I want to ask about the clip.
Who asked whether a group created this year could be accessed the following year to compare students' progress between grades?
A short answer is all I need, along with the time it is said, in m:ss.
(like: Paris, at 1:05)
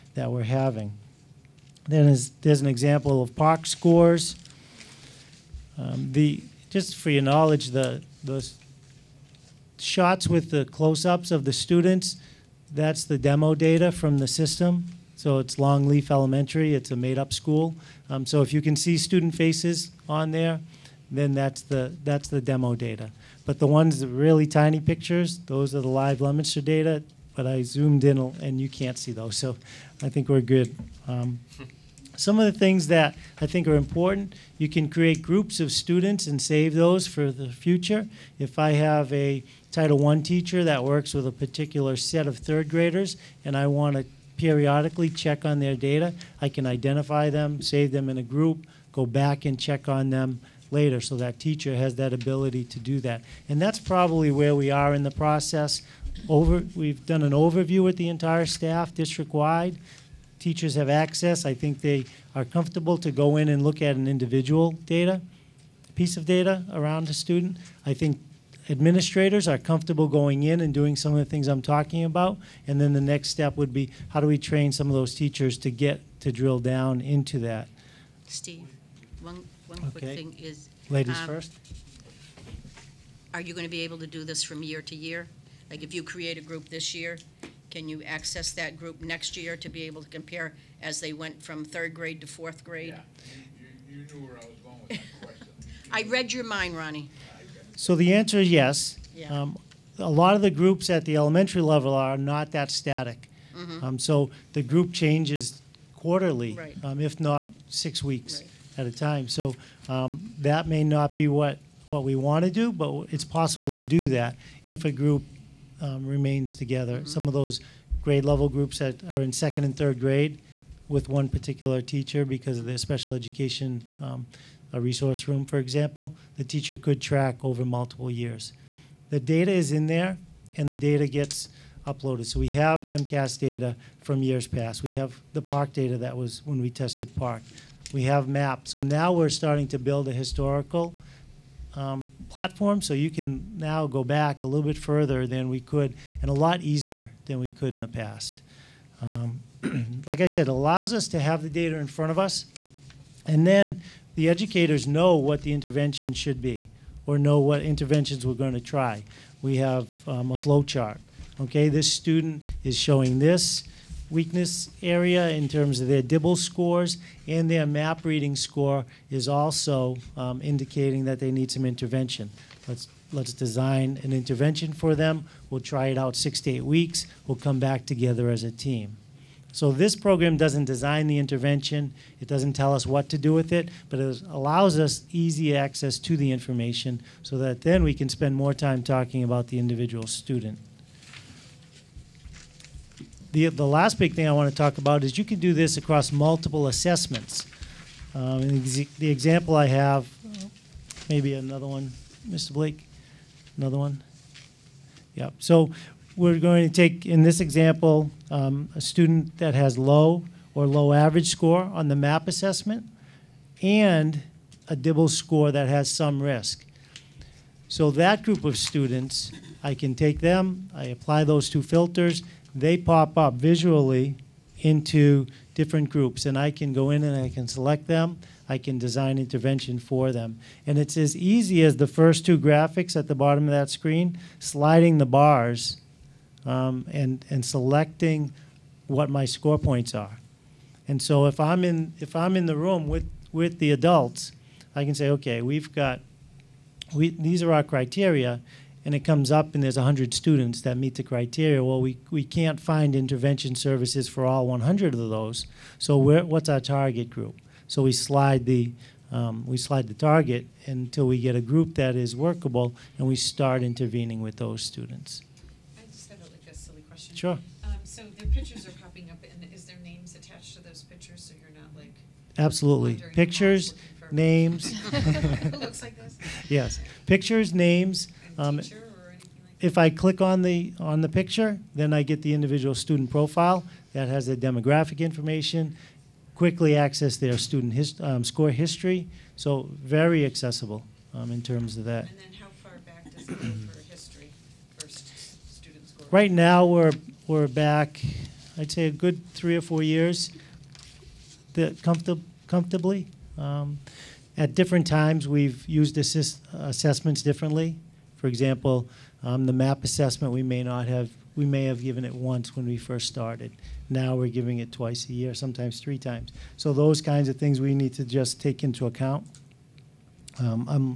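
Ronnie, at 1:36.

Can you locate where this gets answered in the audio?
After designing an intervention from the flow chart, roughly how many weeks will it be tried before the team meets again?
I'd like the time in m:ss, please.
2:56.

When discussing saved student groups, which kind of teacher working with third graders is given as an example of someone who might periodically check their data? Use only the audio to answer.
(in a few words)
Title I teacher.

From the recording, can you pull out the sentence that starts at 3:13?
The, the last big thing I want to talk about is you can do this across multiple assessments.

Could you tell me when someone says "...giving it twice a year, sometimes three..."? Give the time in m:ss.
5:14.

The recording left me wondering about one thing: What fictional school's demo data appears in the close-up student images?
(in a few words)
Longleaf Elementary.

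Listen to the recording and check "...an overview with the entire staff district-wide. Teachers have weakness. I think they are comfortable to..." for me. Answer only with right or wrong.
wrong.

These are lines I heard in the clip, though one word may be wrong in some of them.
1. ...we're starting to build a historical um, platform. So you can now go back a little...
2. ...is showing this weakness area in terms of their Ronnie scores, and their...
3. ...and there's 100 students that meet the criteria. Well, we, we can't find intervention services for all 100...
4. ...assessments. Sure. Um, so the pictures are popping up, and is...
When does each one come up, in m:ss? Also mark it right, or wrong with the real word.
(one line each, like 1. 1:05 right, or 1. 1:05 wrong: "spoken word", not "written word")
1. 2:19 right
2. 2:42 wrong: "DIBELS", not "Ronnie"
3. 4:09 right
4. 4:24 wrong: "students", not "assessments".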